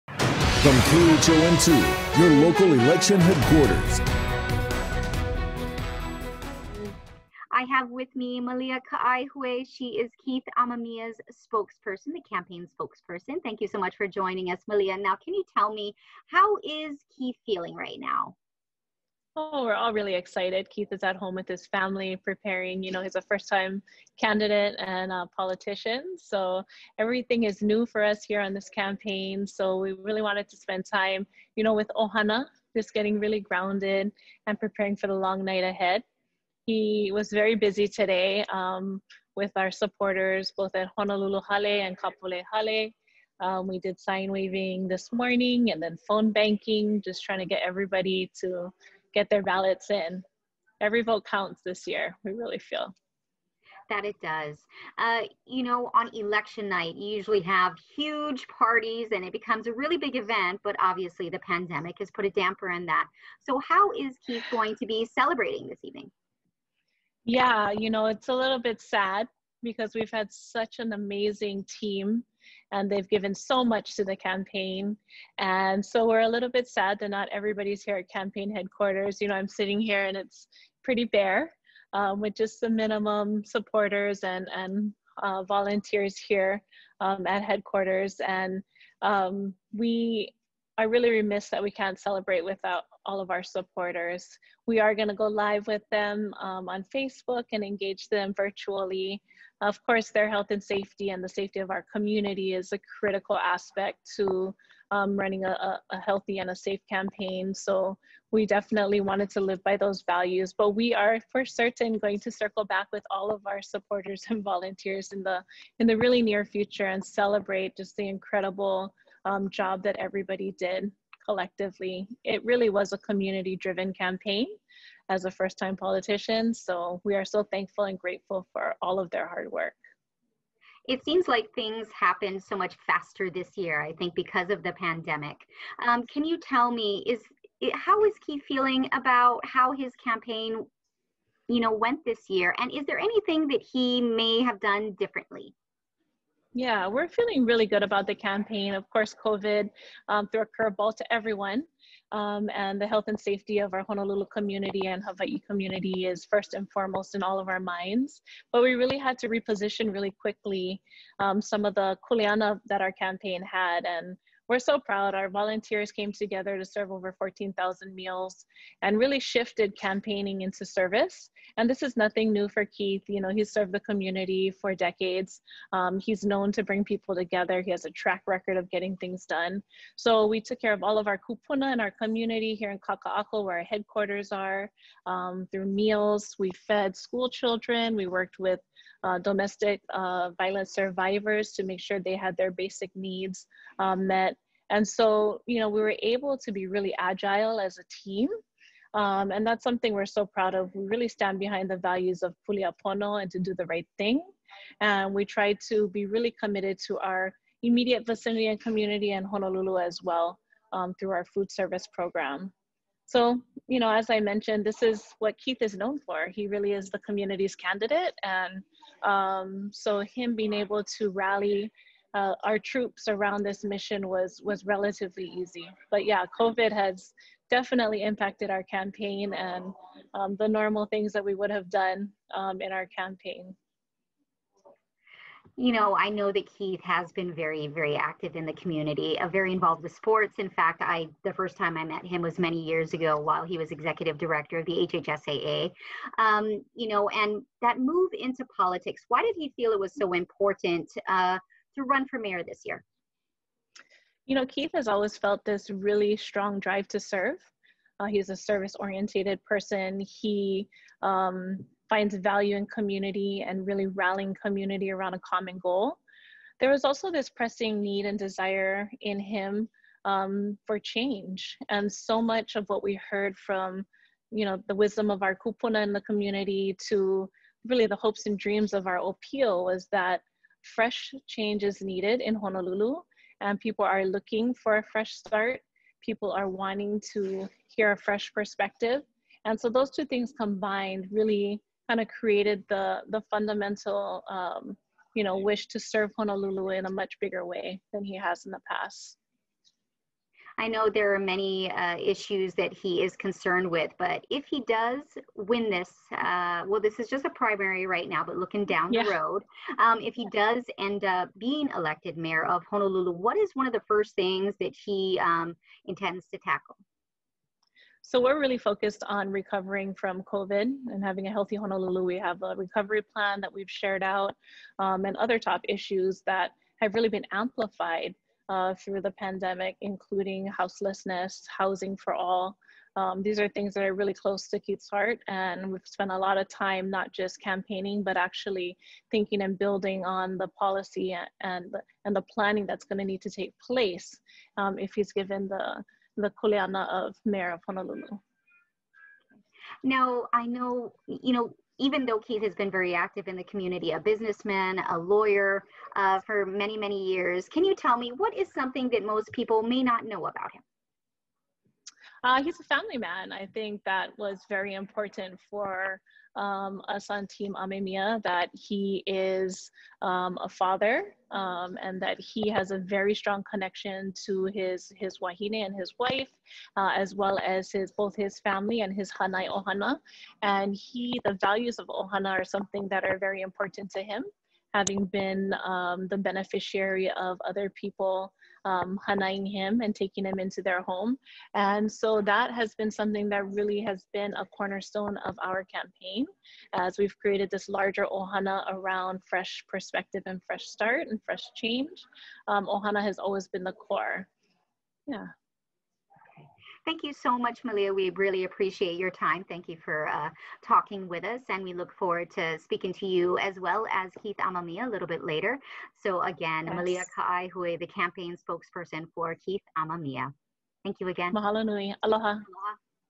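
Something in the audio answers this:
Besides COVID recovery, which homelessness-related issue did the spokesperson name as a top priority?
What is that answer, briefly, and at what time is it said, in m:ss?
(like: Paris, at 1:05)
Houselessness, at 5:30.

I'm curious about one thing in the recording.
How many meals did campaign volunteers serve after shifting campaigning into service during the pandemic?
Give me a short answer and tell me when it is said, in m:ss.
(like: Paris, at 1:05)
14,000, at 2:47.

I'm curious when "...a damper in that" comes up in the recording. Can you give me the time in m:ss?
1:02.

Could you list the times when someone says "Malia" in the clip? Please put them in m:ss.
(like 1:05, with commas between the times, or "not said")
0:08, 0:14, 6:47, 6:56.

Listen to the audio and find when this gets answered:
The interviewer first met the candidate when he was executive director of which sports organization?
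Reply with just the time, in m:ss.
4:04.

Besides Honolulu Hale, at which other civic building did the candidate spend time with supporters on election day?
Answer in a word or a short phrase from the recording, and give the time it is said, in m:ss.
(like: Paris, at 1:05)
Kapolei Hale, at 0:41.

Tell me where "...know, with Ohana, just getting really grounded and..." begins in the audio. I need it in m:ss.
0:31.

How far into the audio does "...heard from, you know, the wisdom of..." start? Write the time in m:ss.
4:33.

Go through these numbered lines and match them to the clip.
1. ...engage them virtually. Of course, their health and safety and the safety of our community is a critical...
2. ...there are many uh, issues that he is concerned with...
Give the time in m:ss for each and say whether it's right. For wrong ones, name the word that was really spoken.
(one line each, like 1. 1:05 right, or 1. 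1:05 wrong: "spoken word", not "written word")
1. 1:37 right
2. 5:00 right.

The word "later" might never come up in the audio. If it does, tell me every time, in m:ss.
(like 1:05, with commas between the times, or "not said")
6:55.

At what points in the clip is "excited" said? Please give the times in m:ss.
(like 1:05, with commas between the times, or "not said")
0:20.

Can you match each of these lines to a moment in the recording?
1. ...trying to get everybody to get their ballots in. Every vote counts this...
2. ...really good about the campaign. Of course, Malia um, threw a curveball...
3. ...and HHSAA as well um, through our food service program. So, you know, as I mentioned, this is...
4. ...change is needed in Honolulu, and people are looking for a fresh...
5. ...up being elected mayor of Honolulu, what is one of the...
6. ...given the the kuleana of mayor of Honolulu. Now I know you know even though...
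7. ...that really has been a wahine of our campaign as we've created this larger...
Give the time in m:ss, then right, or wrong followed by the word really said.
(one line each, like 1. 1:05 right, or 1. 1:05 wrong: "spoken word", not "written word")
1. 0:47 right
2. 2:27 wrong: "COVID", not "Malia"
3. 3:29 wrong: "Honolulu", not "HHSAA"
4. 4:41 right
5. 5:11 right
6. 5:45 right
7. 6:33 wrong: "cornerstone", not "wahine".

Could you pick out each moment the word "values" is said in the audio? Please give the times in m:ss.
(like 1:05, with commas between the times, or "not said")
1:50, 3:21, 4:22, 6:21.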